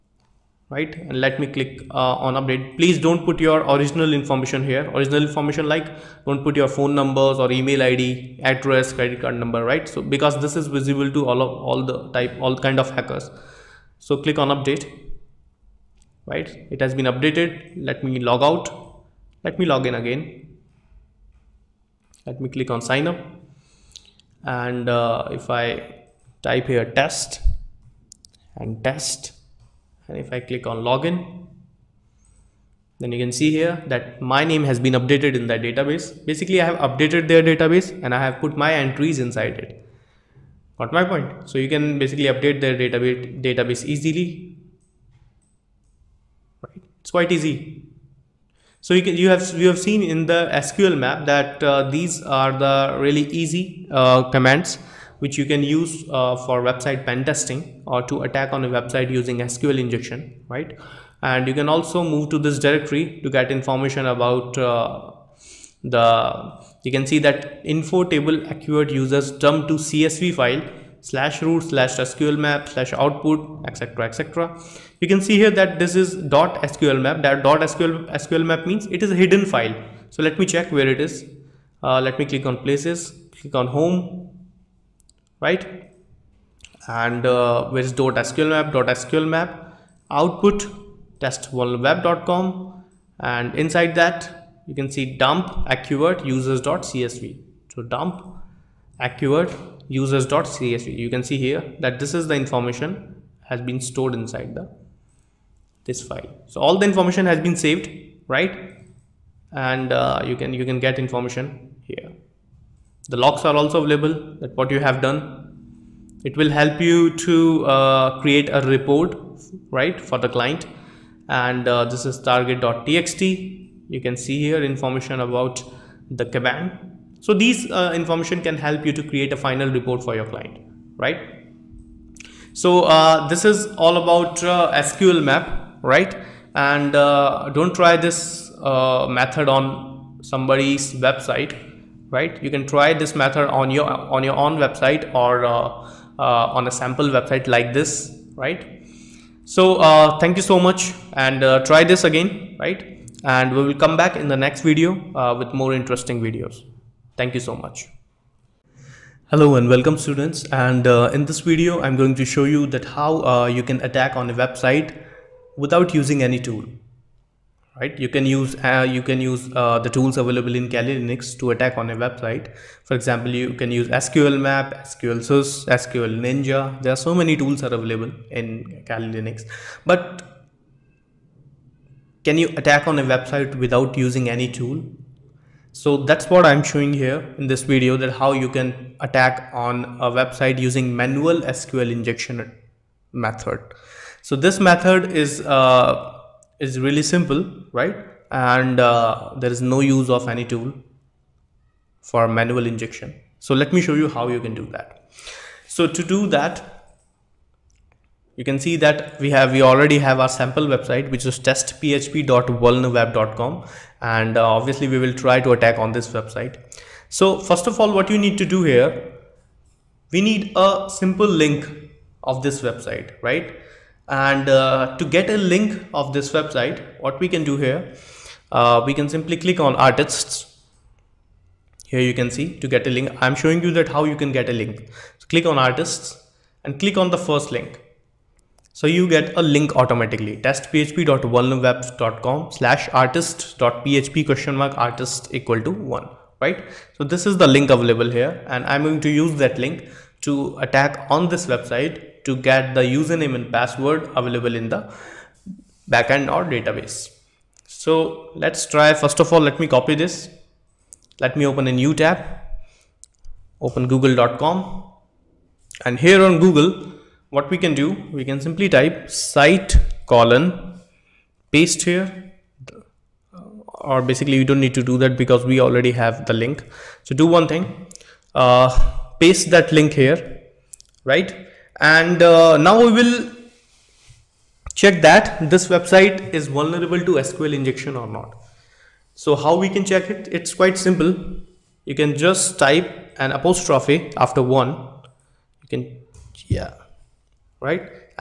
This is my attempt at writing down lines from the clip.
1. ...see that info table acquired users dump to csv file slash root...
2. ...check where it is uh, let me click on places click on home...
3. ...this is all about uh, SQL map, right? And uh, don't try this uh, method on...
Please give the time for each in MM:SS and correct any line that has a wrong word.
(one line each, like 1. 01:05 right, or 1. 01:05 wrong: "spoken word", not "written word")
1. 01:07 right
2. 01:20 right
3. 02:13 right.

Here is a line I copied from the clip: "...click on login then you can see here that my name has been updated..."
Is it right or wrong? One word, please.
right.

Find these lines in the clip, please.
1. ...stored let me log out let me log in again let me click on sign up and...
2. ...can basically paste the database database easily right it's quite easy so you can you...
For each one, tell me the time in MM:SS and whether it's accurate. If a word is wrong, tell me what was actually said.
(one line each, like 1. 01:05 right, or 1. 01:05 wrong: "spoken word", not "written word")
1. 00:17 wrong: "updated", not "stored"
2. 00:41 wrong: "update", not "paste".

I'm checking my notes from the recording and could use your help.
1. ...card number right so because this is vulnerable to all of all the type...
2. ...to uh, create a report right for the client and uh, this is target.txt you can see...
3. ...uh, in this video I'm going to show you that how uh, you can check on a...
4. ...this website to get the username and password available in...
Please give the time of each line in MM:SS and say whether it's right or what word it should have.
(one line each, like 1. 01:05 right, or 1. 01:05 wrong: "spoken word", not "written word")
1. 00:09 wrong: "visible", not "vulnerable"
2. 01:57 right
3. 02:40 wrong: "attack", not "check"
4. 04:11 right.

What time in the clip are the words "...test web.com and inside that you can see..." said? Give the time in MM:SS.
01:31.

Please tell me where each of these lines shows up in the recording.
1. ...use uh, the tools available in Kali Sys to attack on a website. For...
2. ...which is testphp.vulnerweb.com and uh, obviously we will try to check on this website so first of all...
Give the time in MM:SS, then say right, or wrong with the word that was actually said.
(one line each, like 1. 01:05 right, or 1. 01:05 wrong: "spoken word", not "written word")
1. 02:49 wrong: "Linux", not "Sys"
2. 03:31 wrong: "attack", not "check".